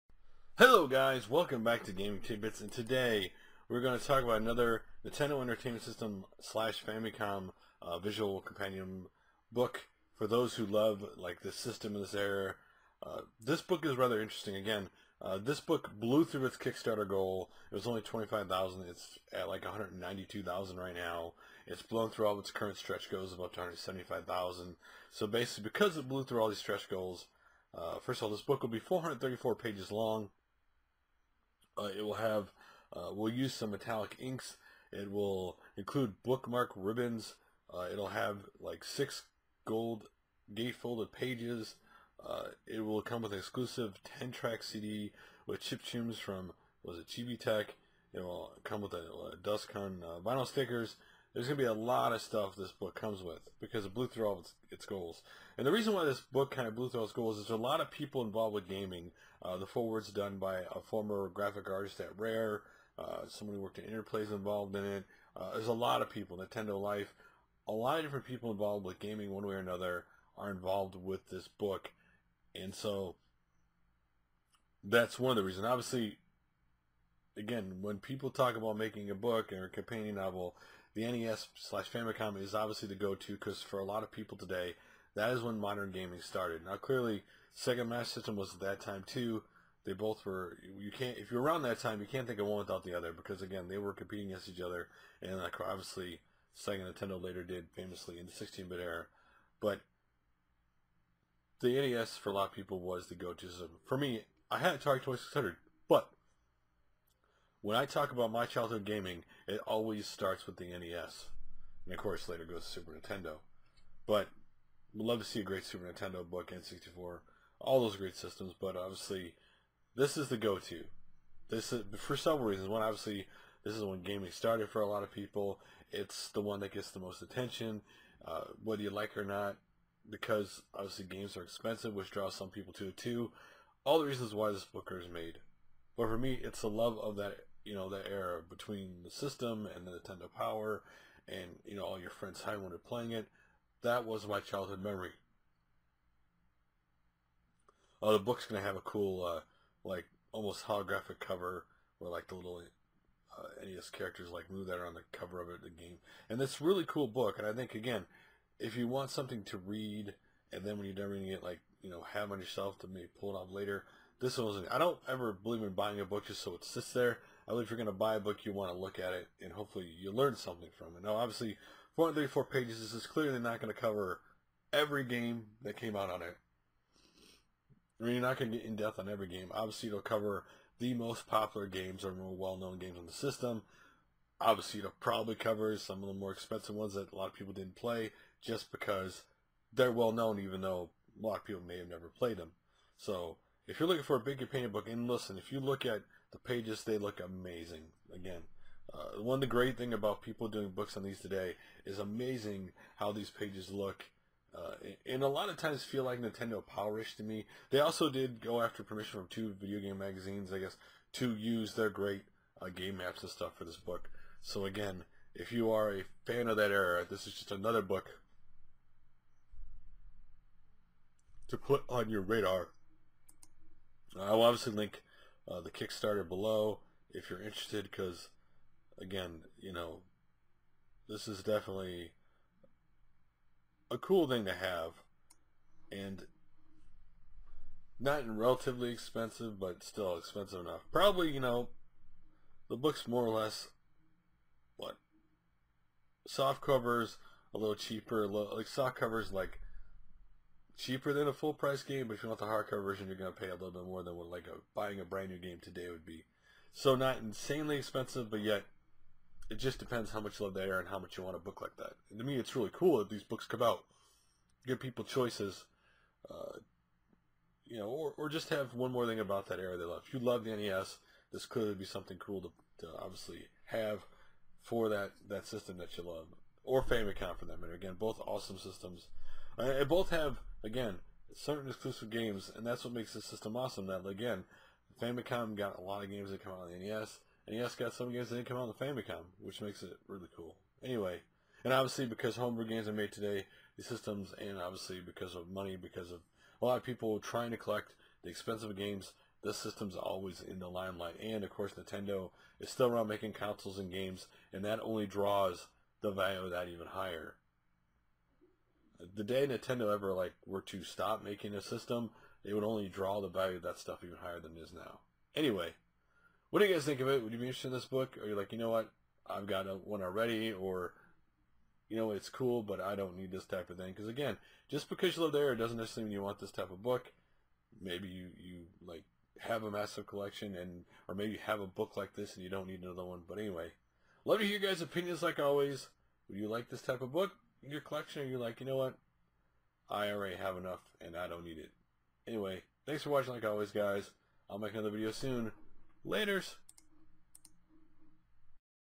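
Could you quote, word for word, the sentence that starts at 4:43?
That again, Famicom got a lot of games that come out on the NES.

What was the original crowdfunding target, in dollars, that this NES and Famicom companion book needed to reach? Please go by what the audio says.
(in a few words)
25,000.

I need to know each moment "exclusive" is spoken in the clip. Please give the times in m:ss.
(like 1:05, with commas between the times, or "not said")
0:43, 4:41.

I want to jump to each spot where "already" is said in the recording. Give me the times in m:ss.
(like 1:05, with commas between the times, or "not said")
5:20, 5:40.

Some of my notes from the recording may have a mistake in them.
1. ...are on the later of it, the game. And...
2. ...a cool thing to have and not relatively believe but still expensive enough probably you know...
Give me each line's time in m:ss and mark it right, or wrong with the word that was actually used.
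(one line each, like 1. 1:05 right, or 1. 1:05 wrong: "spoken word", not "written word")
1. 2:34 wrong: "cover", not "later"
2. 3:53 wrong: "expensive", not "believe".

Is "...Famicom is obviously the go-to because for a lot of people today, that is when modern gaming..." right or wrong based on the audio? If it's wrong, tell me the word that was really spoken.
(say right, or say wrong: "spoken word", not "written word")
right.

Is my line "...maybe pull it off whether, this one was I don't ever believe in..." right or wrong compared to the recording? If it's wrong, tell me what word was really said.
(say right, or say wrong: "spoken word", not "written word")
wrong: "later", not "whether".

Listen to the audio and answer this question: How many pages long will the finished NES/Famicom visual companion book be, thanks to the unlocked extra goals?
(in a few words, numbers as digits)
434.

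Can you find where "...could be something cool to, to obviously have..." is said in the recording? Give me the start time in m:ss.
4:31.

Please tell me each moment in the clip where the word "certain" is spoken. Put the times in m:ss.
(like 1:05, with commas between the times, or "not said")
4:41.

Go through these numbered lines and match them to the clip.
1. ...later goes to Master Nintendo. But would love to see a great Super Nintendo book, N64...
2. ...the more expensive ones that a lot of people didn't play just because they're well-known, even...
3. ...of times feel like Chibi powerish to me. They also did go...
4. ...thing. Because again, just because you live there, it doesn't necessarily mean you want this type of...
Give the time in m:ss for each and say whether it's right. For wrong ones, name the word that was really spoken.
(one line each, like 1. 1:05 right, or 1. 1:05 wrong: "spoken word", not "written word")
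1. 1:52 wrong: "Super", not "Master"
2. 3:06 right
3. 3:25 wrong: "Nintendo", not "Chibi"
4. 5:23 right.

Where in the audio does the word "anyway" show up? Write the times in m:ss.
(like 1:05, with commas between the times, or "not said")
4:50, 5:15, 5:33, 5:42.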